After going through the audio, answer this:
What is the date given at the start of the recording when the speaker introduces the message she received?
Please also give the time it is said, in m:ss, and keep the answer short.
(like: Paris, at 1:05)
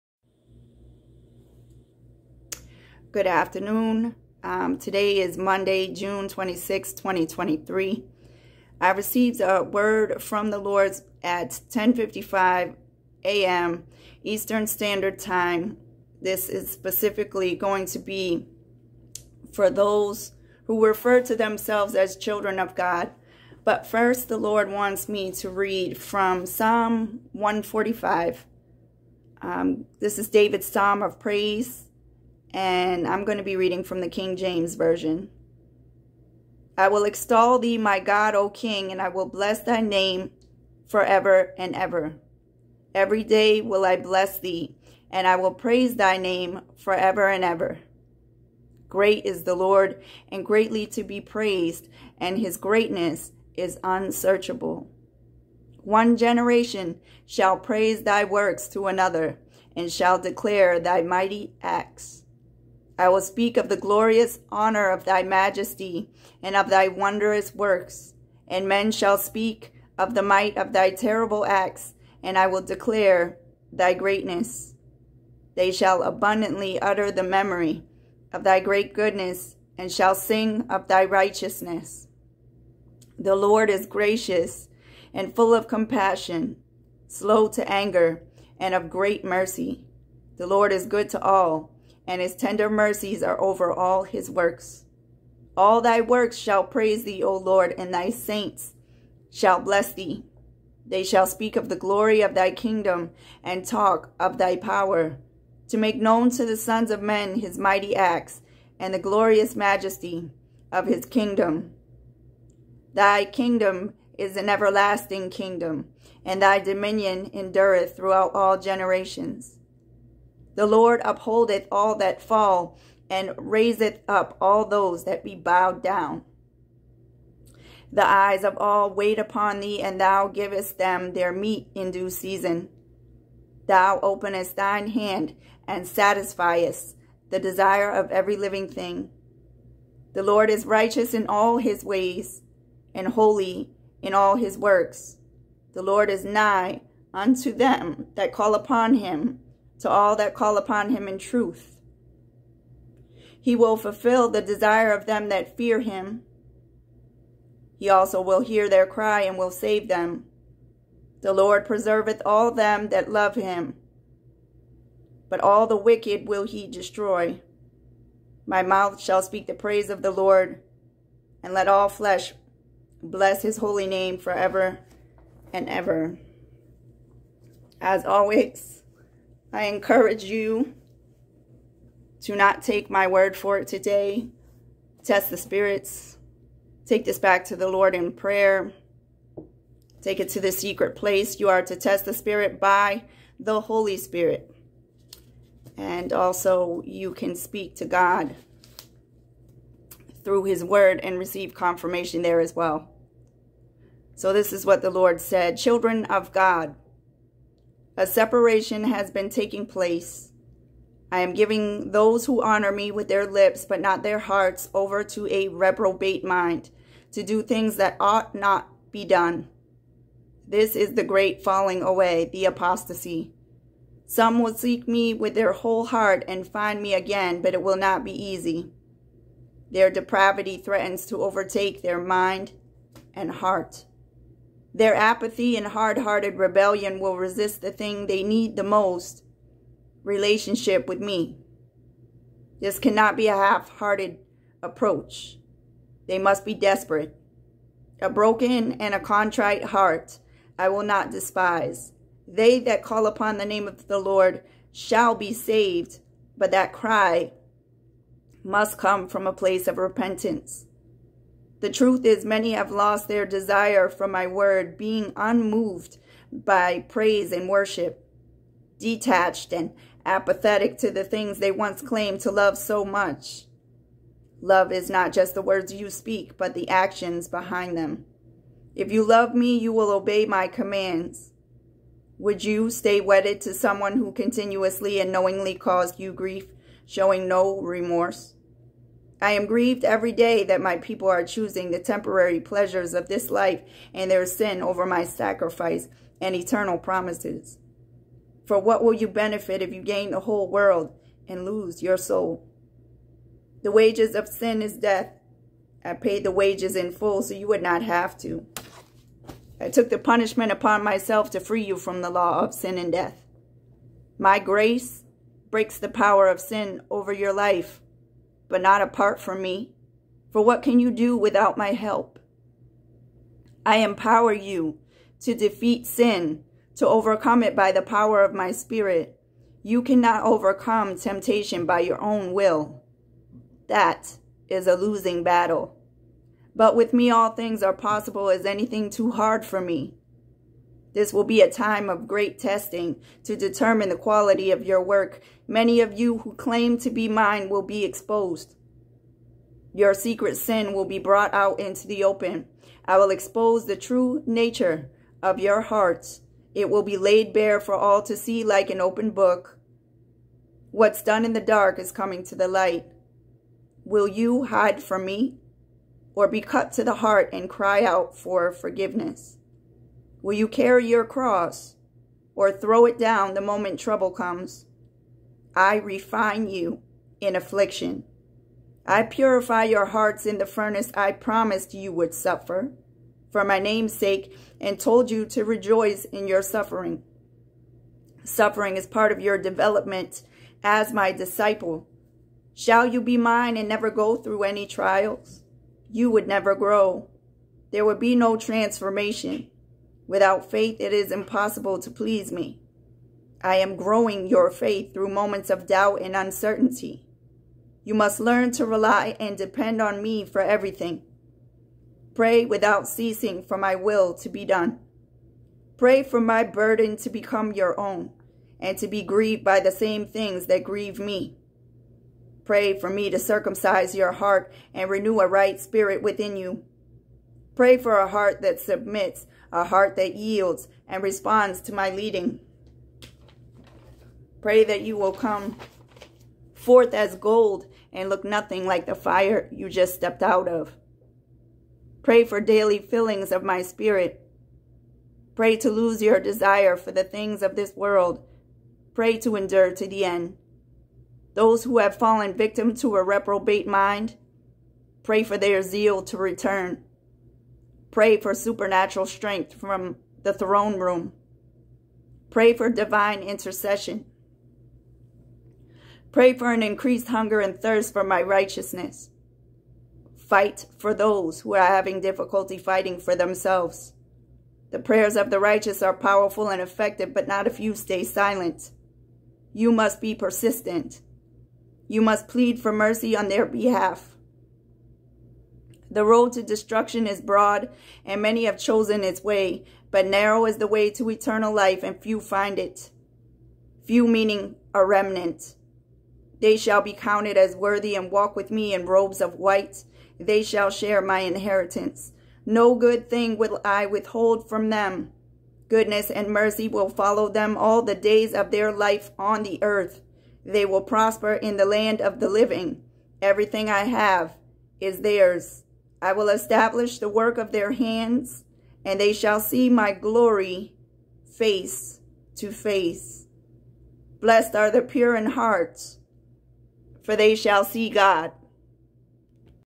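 Monday, June 26, 2023, at 0:05.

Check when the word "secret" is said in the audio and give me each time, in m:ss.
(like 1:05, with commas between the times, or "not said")
3:10, 5:49.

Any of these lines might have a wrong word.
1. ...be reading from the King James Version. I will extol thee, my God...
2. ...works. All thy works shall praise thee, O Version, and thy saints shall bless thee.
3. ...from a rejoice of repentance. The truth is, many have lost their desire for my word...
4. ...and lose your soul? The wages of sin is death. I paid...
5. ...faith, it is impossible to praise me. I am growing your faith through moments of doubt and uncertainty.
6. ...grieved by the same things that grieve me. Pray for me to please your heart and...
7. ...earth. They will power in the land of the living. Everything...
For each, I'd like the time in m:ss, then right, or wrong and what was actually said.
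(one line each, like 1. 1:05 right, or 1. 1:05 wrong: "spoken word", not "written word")
1. 0:33 right
2. 1:34 wrong: "Lord", not "Version"
3. 4:19 wrong: "place", not "rejoice"
4. 5:01 right
5. 6:40 wrong: "please", not "praise"
6. 6:59 wrong: "circumcise", not "please"
7. 8:29 wrong: "prosper", not "power".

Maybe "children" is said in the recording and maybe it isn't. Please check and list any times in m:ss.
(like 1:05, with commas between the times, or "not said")
0:22, 3:25.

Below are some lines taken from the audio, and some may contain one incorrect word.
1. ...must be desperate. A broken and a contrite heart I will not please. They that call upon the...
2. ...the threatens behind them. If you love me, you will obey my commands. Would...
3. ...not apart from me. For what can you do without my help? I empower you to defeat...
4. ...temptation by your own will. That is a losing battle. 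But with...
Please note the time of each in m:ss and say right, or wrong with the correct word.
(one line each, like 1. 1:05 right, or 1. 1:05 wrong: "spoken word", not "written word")
1. 4:06 wrong: "despise", not "please"
2. 4:36 wrong: "actions", not "threatens"
3. 5:18 right
4. 5:30 right.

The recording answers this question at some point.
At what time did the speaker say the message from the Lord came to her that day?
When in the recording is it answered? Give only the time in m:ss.
0:11.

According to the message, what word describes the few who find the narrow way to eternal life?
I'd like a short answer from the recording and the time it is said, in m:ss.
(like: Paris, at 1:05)
a remnant, at 8:14.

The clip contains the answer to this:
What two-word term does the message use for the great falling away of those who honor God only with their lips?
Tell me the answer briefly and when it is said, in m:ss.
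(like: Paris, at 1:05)
the apostasy, at 3:42.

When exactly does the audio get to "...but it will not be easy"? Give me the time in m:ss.
3:47.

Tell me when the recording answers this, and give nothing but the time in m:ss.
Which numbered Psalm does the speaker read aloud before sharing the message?
0:26.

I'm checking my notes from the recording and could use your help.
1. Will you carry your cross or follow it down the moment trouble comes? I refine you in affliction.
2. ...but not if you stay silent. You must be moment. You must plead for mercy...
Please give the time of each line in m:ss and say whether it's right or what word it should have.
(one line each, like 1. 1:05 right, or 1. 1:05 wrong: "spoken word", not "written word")
1. 6:10 wrong: "throw", not "follow"
2. 7:57 wrong: "persistent", not "moment".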